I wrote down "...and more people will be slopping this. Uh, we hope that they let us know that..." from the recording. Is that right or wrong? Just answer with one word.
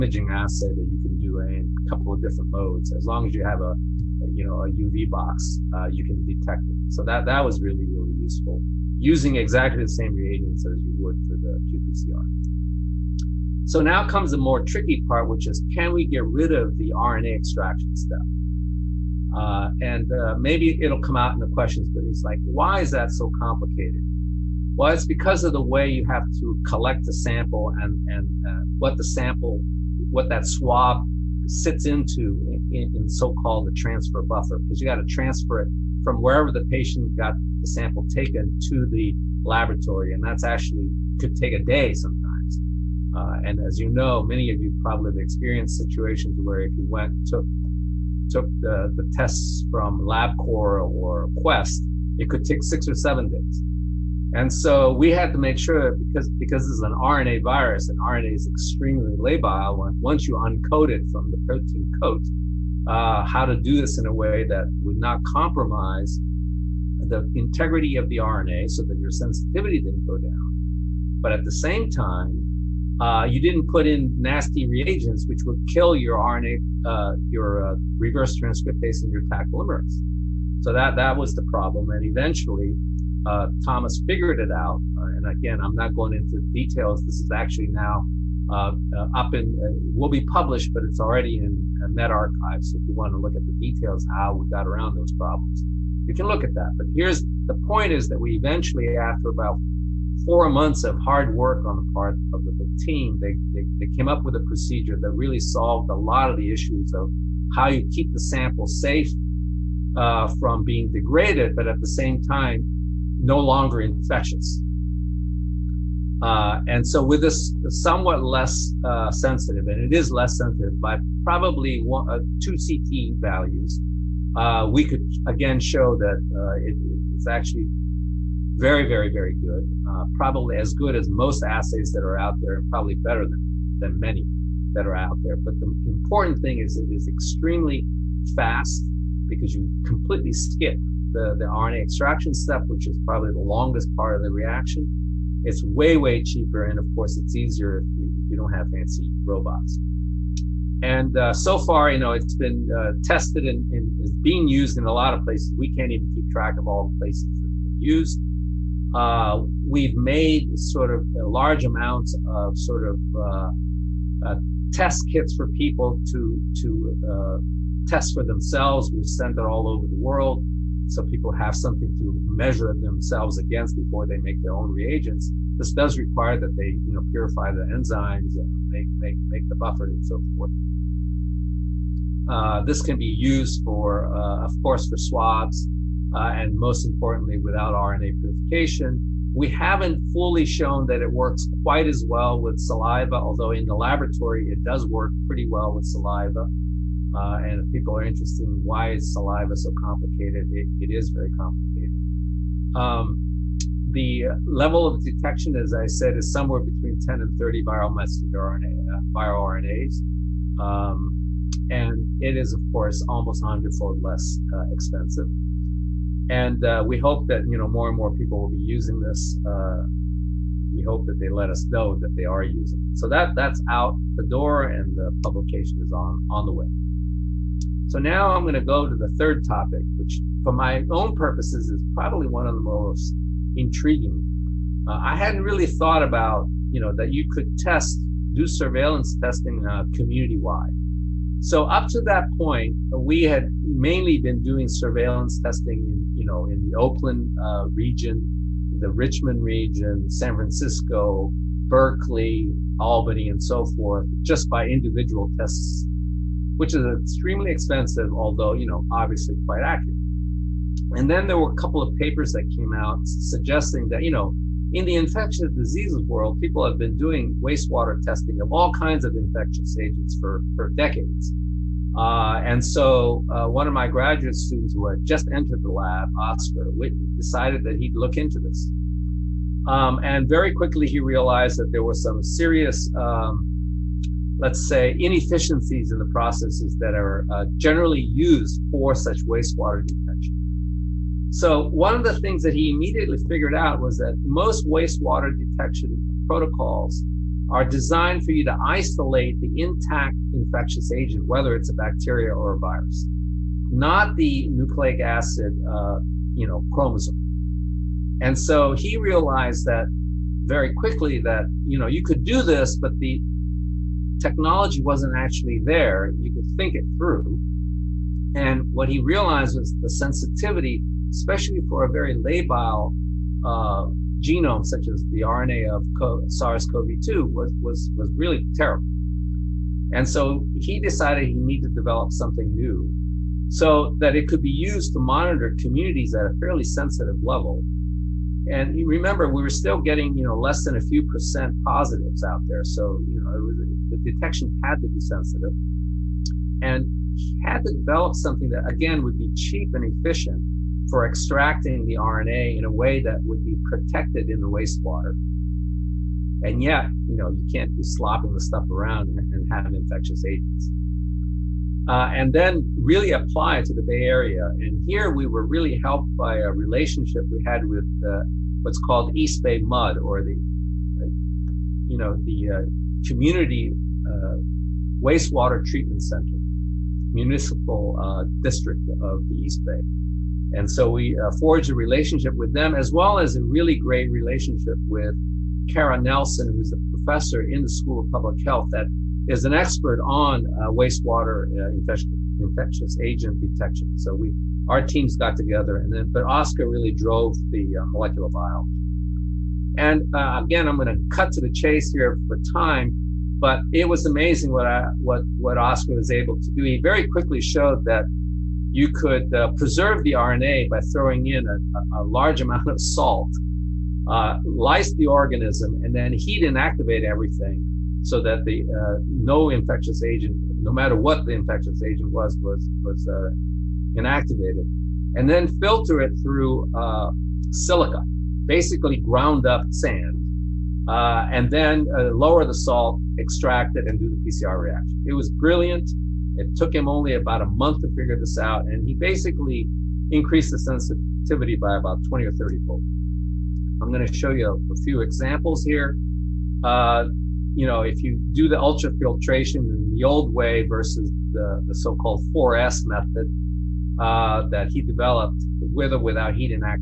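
wrong.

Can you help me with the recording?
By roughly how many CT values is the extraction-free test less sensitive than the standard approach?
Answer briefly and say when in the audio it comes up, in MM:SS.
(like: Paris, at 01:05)
2, at 02:02.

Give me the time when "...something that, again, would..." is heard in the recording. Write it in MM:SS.
05:48.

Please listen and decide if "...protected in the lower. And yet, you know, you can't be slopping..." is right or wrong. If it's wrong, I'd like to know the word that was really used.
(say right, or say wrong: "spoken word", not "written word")
wrong: "wastewater", not "lower".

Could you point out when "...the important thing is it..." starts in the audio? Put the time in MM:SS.
02:15.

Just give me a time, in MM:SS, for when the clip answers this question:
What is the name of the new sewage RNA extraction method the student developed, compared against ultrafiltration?
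07:32.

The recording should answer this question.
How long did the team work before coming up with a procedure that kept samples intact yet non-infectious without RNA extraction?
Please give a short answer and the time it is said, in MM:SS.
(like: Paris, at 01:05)
4 months, at 01:40.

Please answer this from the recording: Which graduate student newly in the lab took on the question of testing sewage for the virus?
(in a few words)
Oscar Whitney.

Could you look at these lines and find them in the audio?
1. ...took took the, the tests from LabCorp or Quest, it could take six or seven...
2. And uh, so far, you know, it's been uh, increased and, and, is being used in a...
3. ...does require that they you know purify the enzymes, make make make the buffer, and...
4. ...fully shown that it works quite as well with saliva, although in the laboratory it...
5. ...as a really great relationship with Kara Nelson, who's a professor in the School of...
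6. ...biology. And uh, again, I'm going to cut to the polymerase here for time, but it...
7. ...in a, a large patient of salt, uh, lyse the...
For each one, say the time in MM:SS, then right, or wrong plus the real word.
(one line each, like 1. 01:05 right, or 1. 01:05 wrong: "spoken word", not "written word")
1. 00:47 right
2. 02:30 wrong: "tested", not "increased"
3. 02:55 right
4. 03:10 right
5. 06:23 right
6. 06:38 wrong: "chase", not "polymerase"
7. 06:51 wrong: "amount", not "patient".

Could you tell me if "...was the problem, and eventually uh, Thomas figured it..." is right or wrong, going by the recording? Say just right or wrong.
right.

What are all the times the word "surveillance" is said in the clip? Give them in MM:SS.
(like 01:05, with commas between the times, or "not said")
03:58, 04:04.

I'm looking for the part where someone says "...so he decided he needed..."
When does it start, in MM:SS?
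05:30.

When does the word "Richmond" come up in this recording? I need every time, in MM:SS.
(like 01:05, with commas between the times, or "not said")
04:08.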